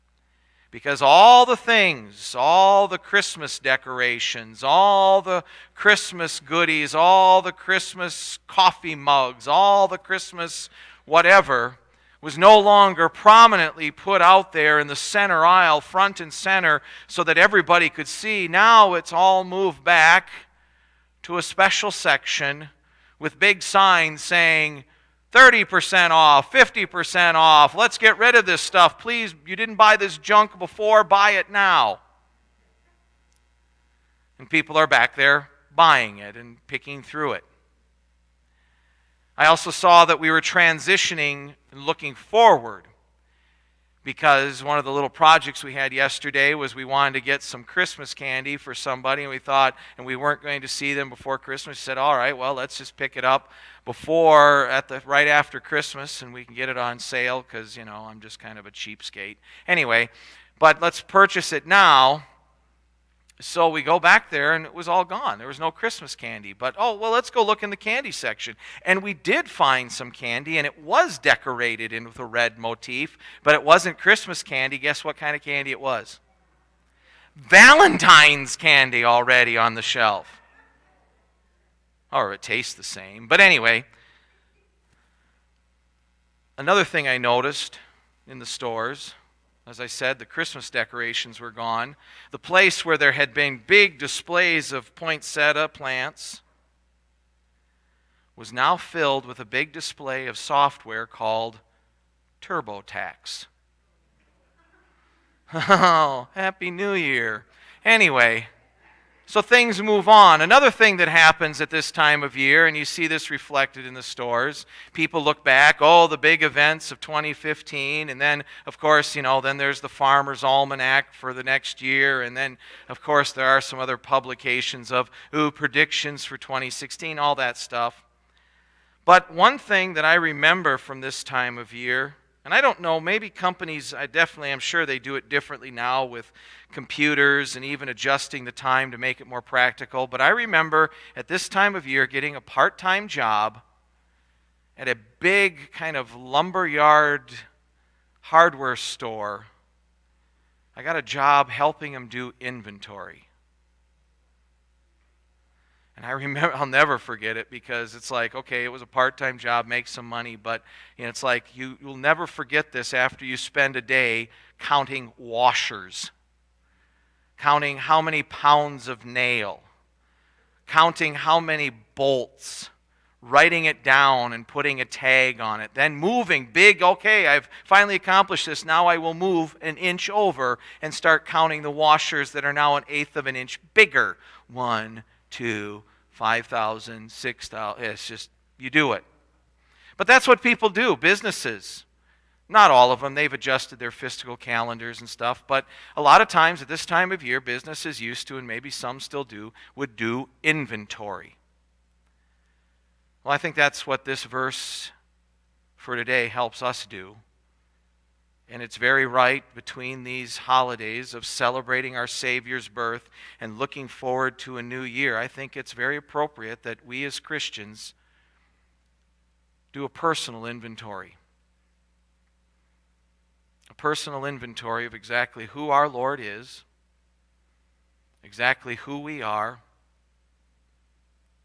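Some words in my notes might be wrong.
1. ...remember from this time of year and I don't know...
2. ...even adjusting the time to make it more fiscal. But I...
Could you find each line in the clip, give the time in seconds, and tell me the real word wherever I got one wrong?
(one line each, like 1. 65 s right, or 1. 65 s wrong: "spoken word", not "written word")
1. 130 s right
2. 137 s wrong: "practical", not "fiscal".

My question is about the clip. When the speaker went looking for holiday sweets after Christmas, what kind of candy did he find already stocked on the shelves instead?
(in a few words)
Valentine's candy.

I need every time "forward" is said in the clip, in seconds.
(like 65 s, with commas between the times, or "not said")
42 s, 213 s.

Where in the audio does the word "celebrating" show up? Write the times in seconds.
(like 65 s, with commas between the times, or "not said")
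211 s.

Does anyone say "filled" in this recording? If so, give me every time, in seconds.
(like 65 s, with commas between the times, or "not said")
98 s.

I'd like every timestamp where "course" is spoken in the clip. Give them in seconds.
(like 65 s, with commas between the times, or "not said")
118 s, 123 s.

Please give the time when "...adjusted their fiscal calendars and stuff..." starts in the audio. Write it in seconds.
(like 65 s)
193 s.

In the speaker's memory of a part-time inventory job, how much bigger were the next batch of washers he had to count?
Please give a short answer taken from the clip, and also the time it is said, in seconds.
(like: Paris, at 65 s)
an eighth of an inch, at 182 s.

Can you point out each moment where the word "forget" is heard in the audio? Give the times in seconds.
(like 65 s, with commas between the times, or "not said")
156 s, 162 s.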